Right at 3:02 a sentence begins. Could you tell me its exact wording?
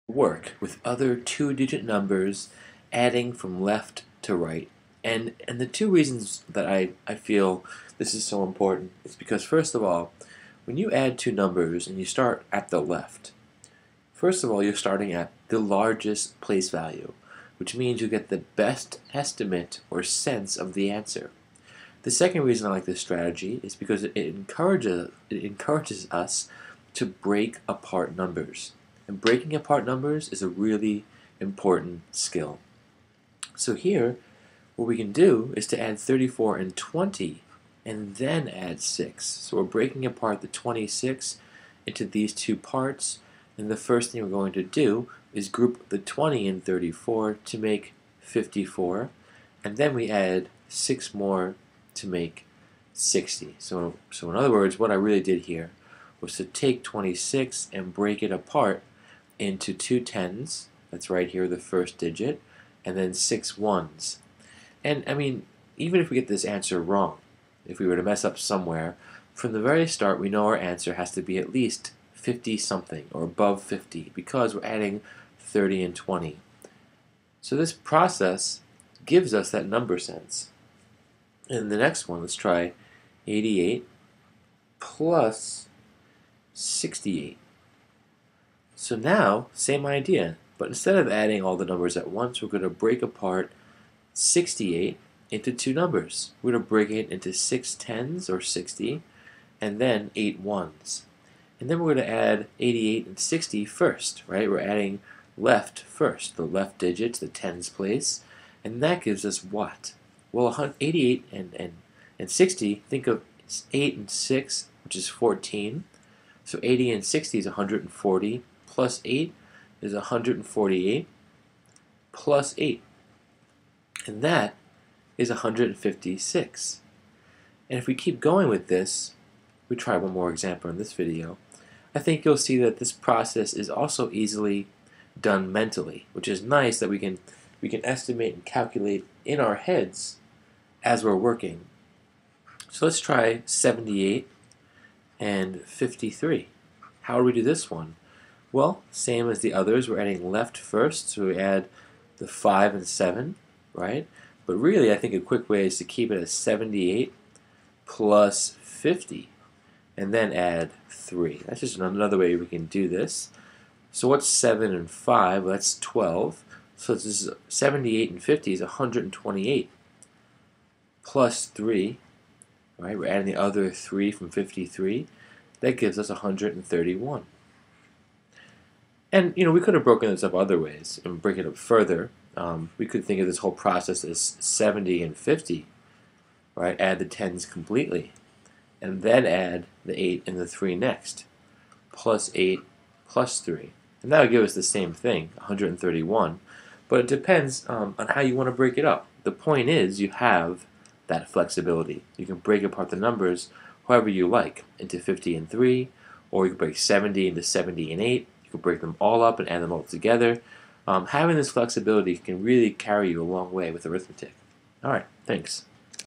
Um, we could think of this whole process as 70 and 50, right?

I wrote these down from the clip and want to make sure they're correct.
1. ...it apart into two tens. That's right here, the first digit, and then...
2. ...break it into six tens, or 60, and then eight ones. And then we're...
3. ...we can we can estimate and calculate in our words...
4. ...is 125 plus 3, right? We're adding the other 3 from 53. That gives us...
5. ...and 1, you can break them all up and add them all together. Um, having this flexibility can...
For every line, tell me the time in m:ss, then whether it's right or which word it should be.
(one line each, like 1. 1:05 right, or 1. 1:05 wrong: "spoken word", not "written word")
1. 0:58 right
2. 1:36 right
3. 2:16 wrong: "heads", not "words"
4. 2:48 wrong: "128", not "125"
5. 3:27 wrong: "8", not "1".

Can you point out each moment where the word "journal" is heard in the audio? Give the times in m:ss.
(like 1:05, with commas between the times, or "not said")
not said.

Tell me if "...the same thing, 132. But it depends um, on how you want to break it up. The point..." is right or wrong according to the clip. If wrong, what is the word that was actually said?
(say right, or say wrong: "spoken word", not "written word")
wrong: "131", not "132".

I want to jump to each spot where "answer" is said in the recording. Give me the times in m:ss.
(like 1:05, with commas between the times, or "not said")
0:20, 1:06, 1:10.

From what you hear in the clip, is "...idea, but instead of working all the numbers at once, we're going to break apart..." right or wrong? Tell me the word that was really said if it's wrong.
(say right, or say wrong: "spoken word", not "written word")
wrong: "adding", not "working".